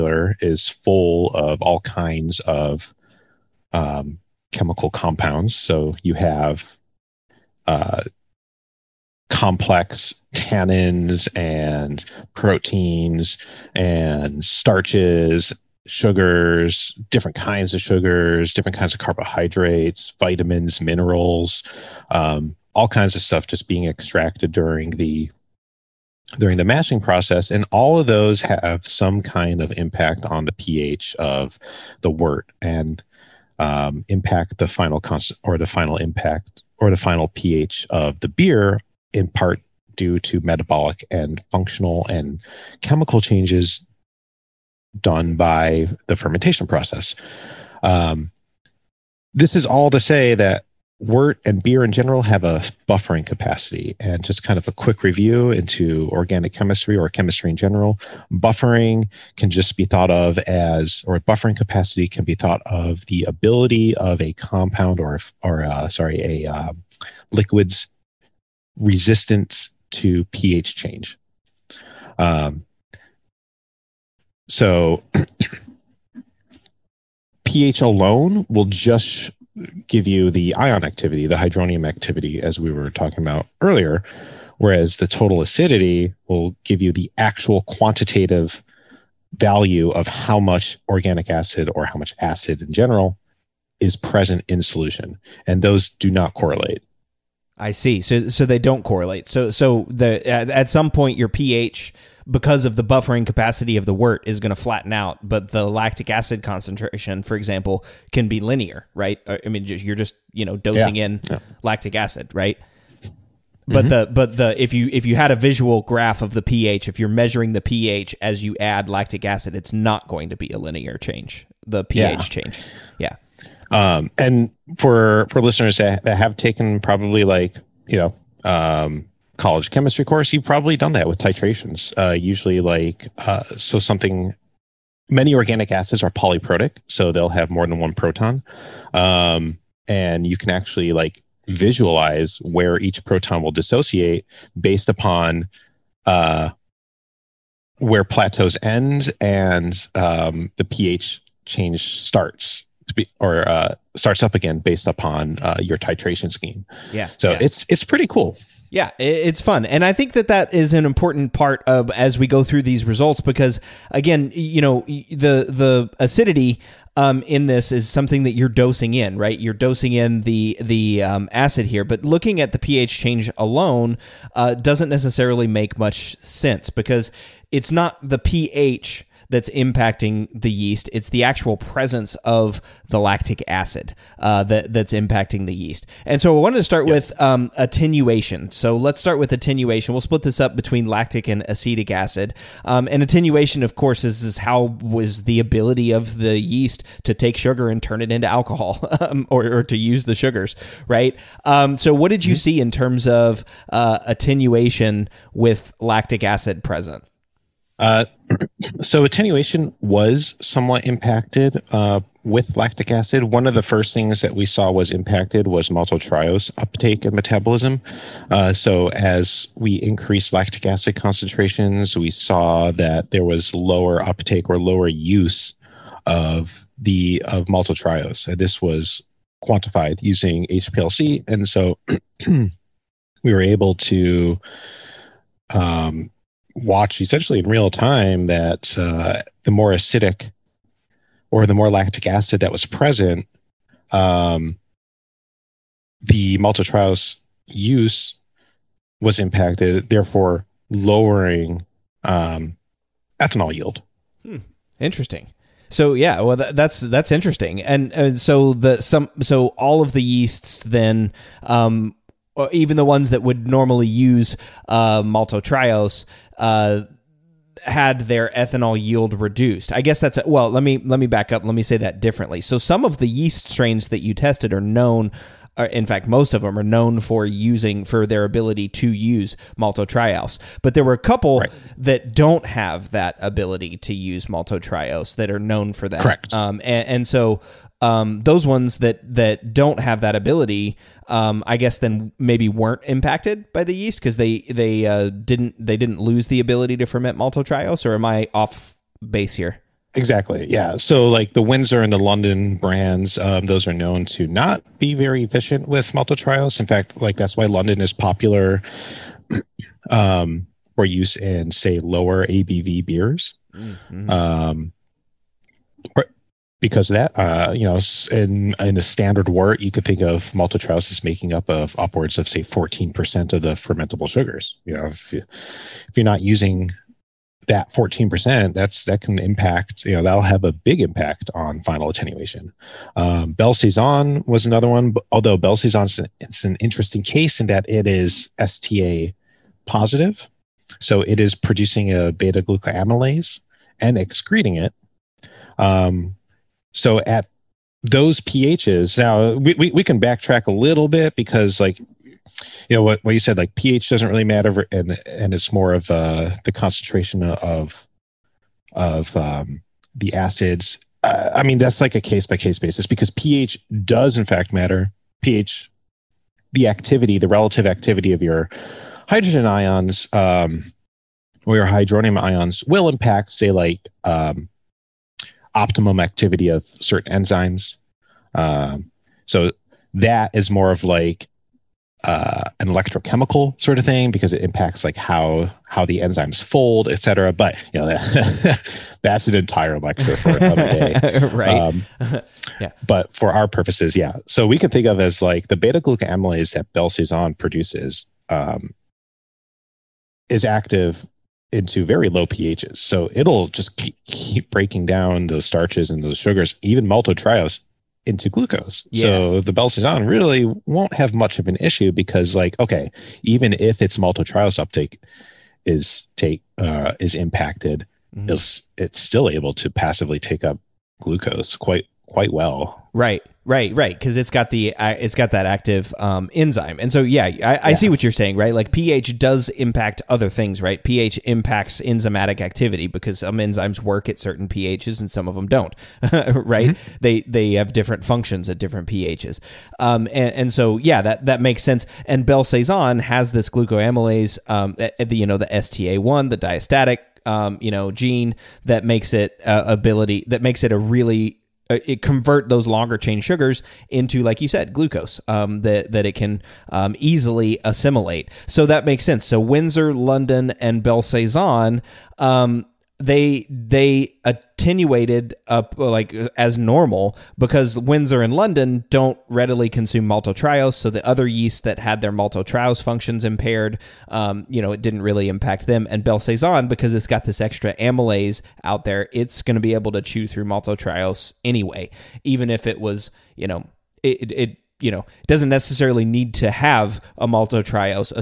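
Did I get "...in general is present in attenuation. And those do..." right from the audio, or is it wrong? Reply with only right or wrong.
wrong.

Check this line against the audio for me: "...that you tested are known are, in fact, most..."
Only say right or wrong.
right.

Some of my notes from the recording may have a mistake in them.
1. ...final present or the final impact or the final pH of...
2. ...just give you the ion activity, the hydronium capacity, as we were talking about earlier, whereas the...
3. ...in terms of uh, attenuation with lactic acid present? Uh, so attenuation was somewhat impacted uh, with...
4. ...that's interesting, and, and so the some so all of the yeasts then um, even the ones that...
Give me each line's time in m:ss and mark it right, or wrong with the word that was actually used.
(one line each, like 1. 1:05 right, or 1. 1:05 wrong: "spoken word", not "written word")
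1. 0:34 wrong: "constant", not "present"
2. 1:18 wrong: "activity", not "capacity"
3. 3:22 right
4. 4:16 right.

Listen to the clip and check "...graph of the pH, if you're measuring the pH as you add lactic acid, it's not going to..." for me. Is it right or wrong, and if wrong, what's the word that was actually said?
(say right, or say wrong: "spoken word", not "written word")
right.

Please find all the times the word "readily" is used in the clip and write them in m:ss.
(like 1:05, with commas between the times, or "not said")
7:49.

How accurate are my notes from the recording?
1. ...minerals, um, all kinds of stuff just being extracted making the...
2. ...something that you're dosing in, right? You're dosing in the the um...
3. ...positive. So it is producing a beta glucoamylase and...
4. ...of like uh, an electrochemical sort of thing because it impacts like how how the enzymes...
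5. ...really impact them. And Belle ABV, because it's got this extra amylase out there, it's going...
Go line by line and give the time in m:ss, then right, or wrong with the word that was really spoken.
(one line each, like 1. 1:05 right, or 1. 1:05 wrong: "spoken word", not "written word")
1. 0:20 wrong: "during", not "making"
2. 2:47 right
3. 5:39 right
4. 6:20 right
5. 7:55 wrong: "Saison", not "ABV".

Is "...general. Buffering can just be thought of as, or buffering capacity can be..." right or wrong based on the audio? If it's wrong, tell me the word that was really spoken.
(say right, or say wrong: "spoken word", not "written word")
right.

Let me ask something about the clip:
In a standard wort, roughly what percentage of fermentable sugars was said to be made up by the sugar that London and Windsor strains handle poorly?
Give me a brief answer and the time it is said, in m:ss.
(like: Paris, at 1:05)
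14%, at 5:22.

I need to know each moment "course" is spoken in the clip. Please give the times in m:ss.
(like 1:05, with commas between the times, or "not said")
2:10, 3:13.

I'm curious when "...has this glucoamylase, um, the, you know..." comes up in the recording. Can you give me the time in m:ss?
7:22.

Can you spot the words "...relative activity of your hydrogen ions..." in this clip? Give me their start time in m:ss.
6:07.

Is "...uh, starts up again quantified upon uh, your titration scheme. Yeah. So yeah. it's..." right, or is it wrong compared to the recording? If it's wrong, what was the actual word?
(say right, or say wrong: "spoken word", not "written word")
wrong: "based", not "quantified".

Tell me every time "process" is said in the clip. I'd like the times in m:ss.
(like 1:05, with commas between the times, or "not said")
0:27, 0:46.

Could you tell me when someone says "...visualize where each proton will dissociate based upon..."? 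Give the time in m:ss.
2:21.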